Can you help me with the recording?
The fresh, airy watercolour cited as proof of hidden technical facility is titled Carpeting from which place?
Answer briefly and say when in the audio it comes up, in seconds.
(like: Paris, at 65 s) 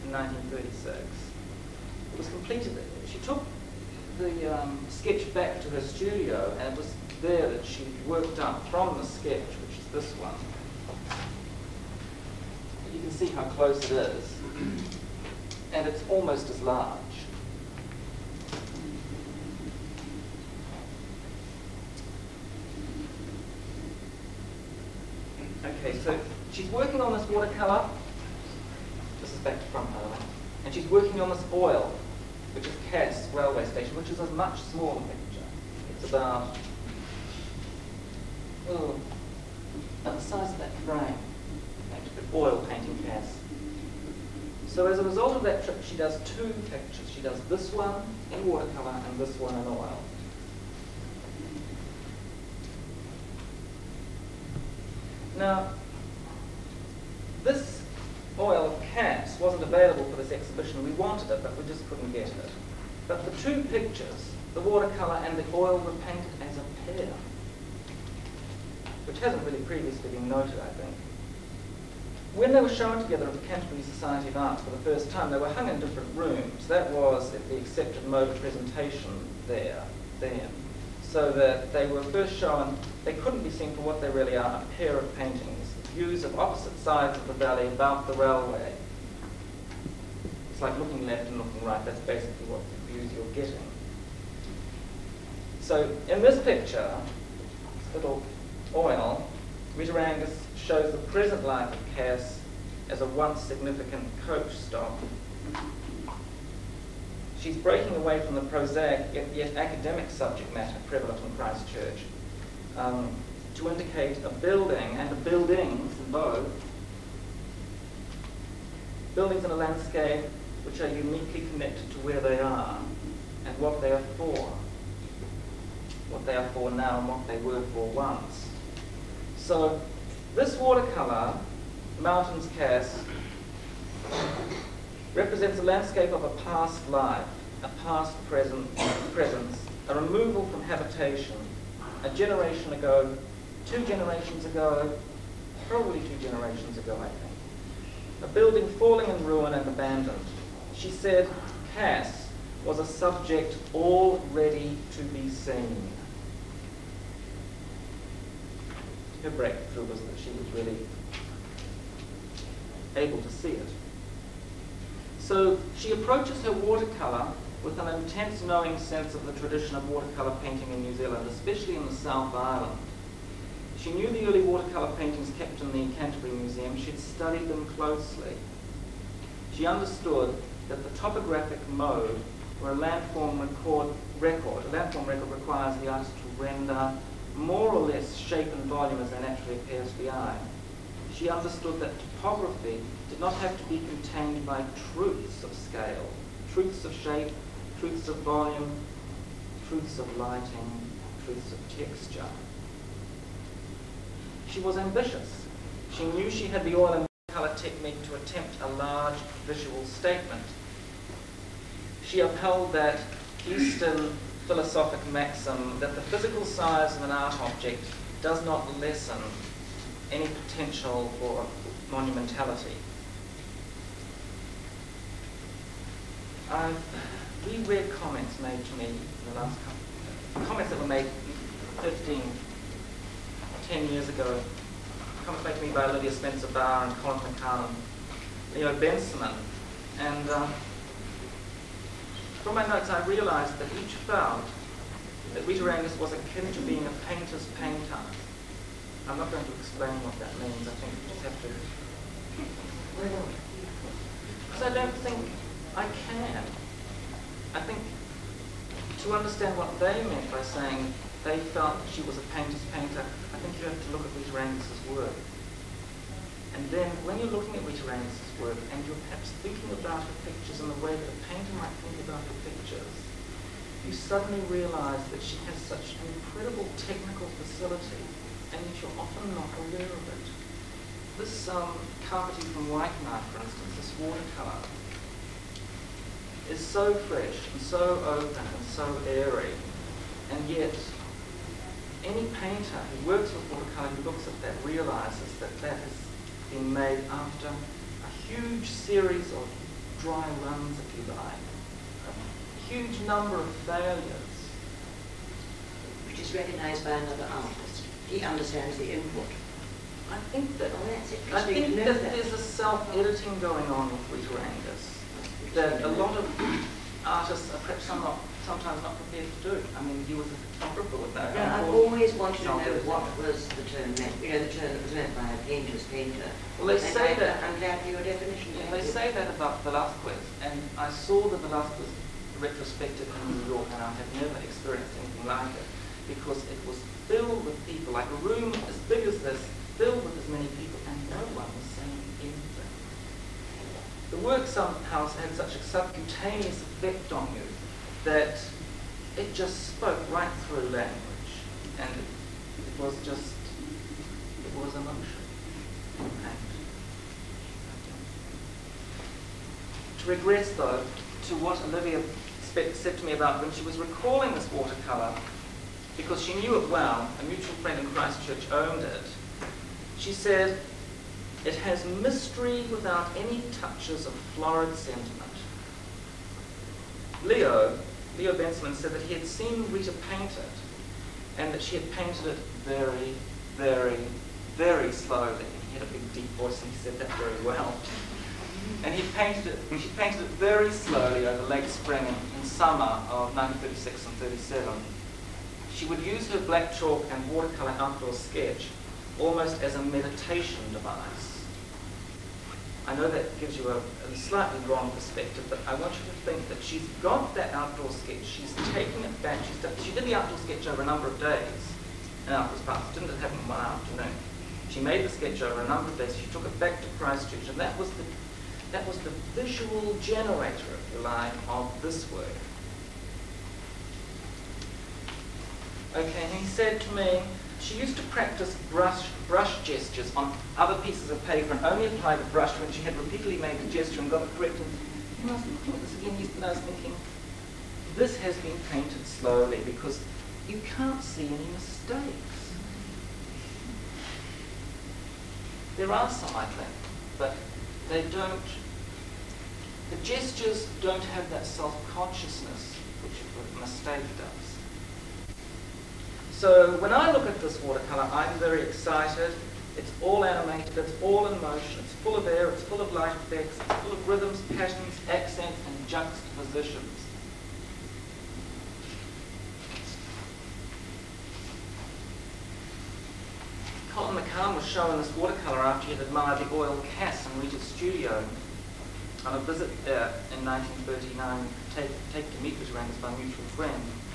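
Waikanae, at 282 s.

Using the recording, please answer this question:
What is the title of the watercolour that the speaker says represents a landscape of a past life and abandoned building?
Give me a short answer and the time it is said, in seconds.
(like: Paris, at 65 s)
Mountains Cass, at 131 s.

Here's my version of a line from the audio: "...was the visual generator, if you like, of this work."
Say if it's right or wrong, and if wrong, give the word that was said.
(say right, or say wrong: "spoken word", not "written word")
right.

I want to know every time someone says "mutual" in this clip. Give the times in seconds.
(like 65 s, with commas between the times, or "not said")
367 s, 483 s.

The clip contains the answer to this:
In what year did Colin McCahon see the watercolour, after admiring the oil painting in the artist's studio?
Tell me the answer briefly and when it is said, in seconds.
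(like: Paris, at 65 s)
1939, at 480 s.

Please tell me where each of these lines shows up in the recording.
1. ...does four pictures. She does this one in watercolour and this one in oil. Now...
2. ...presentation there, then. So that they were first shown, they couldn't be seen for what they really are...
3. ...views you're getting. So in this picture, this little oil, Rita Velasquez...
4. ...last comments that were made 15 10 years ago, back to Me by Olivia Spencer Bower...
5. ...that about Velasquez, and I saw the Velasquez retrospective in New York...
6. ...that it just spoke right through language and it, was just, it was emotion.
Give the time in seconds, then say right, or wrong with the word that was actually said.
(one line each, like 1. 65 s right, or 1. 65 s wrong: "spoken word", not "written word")
1. 45 s wrong: "two", not "four"
2. 78 s right
3. 92 s wrong: "Angus", not "Velasquez"
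4. 229 s right
5. 329 s right
6. 348 s right.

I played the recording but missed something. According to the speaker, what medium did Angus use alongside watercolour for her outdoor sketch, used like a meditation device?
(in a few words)
Black chalk.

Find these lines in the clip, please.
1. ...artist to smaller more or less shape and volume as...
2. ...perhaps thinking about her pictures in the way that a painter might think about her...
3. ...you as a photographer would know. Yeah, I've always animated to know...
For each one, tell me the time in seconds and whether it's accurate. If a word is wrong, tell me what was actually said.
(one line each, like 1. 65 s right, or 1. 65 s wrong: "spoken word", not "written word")
1. 185 s wrong: "render", not "smaller"
2. 269 s right
3. 320 s wrong: "wanted", not "animated".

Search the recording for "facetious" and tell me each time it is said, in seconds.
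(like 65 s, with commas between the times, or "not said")
not said.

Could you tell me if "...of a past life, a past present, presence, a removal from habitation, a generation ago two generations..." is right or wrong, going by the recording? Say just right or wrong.
right.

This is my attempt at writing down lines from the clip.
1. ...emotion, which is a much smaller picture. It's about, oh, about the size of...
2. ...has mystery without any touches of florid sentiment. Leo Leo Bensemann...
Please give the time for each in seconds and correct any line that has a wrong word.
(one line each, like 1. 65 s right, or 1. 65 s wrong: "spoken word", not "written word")
1. 33 s wrong: "station", not "emotion"
2. 371 s right.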